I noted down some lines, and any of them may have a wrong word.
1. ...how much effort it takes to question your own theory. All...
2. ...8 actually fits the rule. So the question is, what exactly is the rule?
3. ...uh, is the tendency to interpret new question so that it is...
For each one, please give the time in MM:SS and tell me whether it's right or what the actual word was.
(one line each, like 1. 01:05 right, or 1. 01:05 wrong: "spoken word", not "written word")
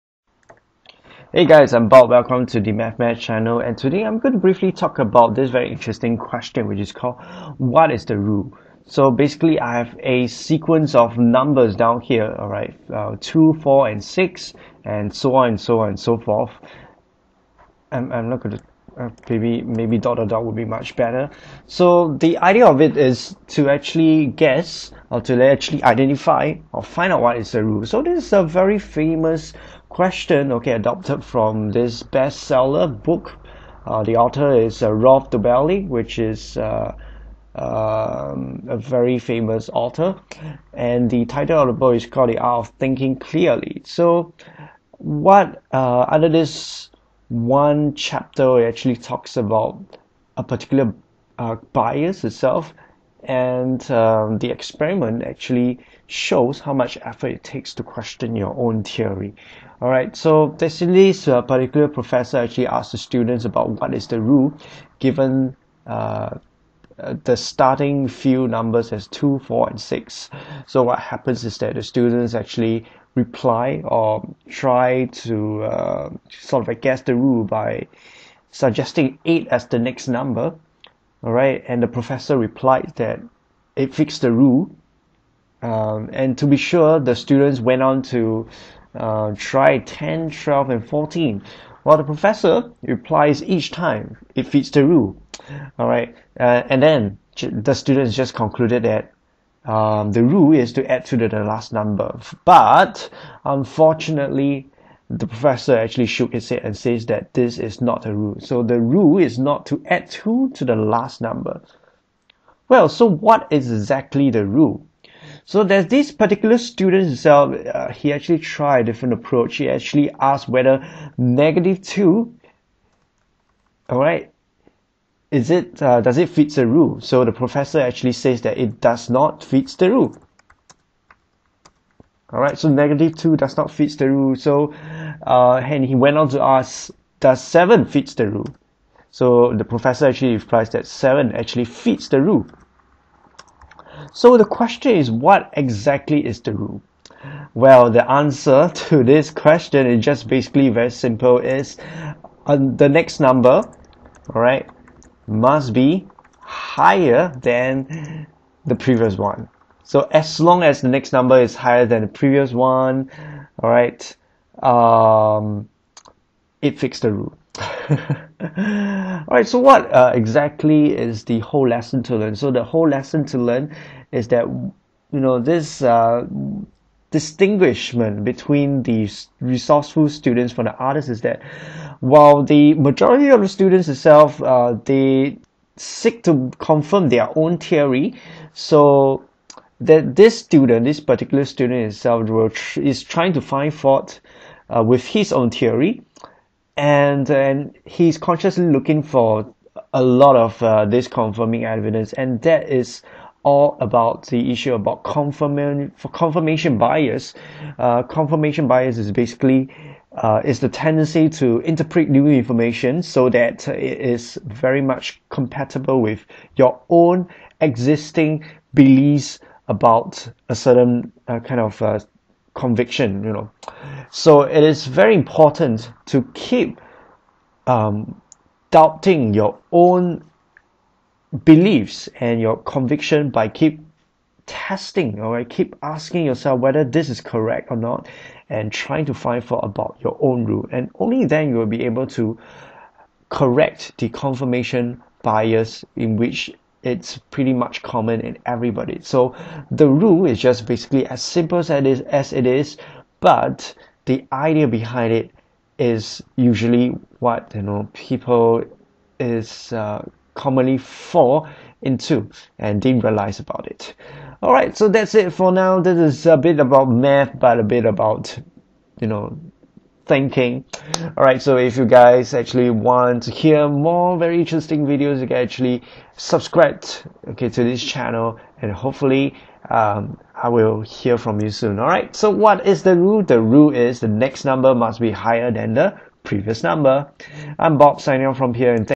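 1. 00:56 right
2. 02:20 wrong: "7", not "8"
3. 03:30 wrong: "information", not "question".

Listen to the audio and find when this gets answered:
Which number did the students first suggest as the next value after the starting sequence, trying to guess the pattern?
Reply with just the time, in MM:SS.
01:19.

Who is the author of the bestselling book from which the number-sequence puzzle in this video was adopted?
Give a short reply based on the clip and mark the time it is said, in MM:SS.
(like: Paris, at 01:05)
Rolf Dobelli, at 00:34.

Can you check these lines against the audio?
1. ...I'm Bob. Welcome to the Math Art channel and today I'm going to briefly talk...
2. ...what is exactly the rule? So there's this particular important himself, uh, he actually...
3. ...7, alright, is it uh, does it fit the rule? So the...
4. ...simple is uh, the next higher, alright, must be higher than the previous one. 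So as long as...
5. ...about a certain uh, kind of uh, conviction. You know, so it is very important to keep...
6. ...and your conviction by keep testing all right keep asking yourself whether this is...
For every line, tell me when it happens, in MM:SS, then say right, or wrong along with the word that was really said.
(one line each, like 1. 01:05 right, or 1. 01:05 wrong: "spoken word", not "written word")
1. 00:01 wrong: "Match", not "Art"
2. 01:53 wrong: "student", not "important"
3. 02:01 wrong: "2", not "7"
4. 02:30 wrong: "number", not "higher"
5. 03:39 right
6. 03:52 right.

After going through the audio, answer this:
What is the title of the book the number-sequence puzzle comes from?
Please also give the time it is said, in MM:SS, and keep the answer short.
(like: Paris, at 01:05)
The Art of Thinking Clearly, at 00:42.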